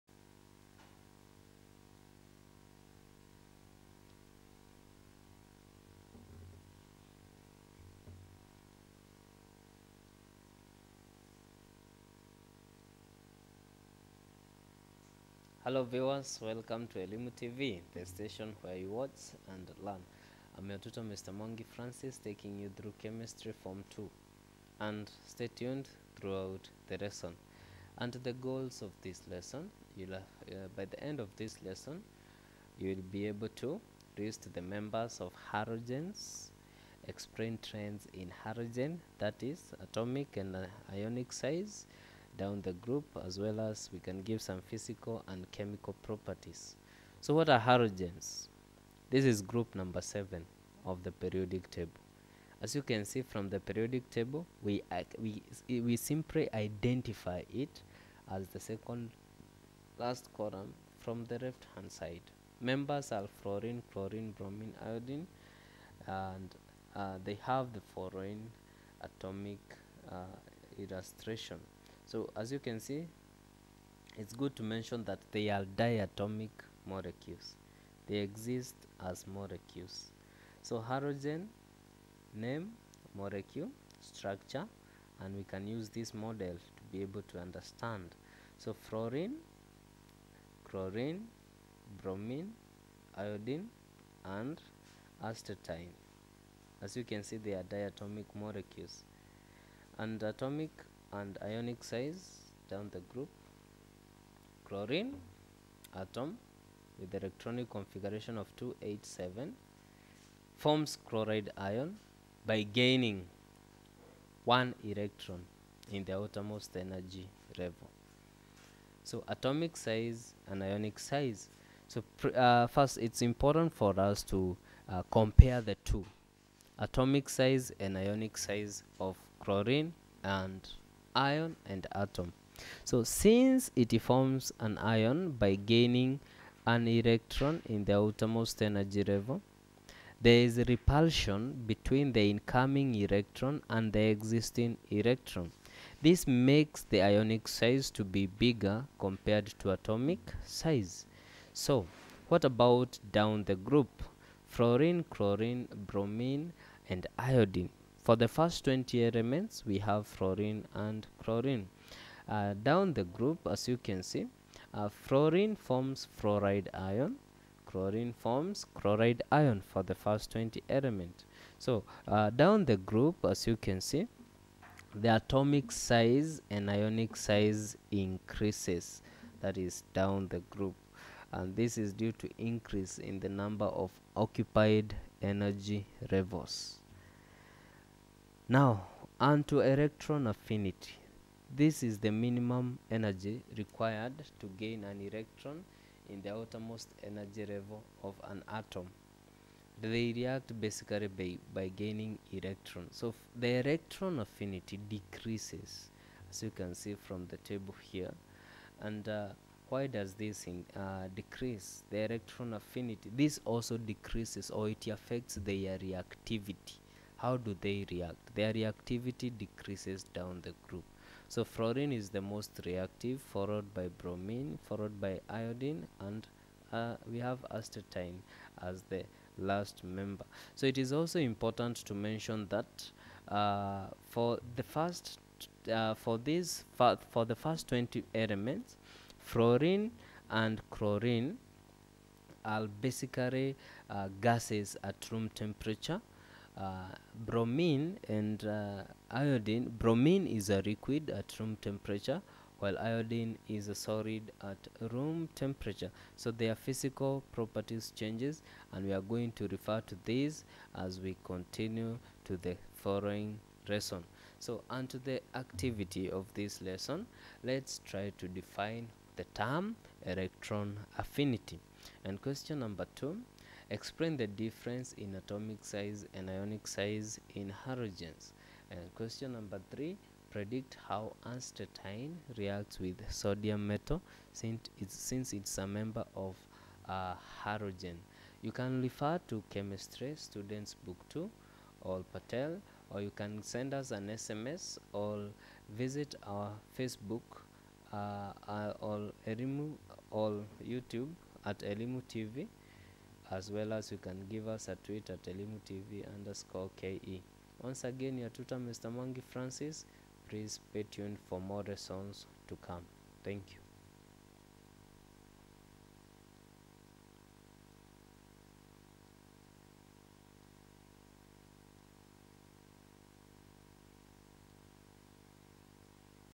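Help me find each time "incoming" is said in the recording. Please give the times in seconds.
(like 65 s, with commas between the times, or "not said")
142 s.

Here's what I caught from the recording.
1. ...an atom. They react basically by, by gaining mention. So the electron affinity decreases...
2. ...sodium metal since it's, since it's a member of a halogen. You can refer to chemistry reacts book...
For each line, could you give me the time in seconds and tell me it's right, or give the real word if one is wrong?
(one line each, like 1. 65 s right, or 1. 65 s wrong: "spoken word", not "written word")
1. 198 s wrong: "electron", not "mention"
2. 283 s wrong: "students", not "reacts".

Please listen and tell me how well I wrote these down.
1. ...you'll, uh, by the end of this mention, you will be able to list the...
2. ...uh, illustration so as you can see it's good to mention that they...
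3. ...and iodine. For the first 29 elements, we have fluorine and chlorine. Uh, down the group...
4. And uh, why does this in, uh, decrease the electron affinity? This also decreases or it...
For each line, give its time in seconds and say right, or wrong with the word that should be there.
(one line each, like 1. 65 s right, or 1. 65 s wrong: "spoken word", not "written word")
1. 29 s wrong: "lesson", not "mention"
2. 70 s right
3. 156 s wrong: "20", not "29"
4. 208 s right.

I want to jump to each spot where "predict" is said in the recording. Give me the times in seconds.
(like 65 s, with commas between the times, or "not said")
280 s.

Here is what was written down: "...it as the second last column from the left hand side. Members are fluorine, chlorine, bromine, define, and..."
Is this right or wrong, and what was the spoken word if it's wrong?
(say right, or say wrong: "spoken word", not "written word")
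wrong: "iodine", not "define".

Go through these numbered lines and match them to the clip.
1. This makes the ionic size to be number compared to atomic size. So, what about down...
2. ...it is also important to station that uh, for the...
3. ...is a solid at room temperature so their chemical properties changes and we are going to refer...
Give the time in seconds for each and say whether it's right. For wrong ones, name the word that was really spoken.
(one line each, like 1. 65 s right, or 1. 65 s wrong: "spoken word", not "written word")
1. 146 s wrong: "bigger", not "number"
2. 230 s wrong: "mention", not "station"
3. 253 s wrong: "physical", not "chemical".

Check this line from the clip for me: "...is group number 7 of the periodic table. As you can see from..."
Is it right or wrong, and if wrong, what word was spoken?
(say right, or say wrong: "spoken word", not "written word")
right.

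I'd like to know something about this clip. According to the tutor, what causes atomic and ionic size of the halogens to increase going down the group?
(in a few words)
Number of occupied energy levels.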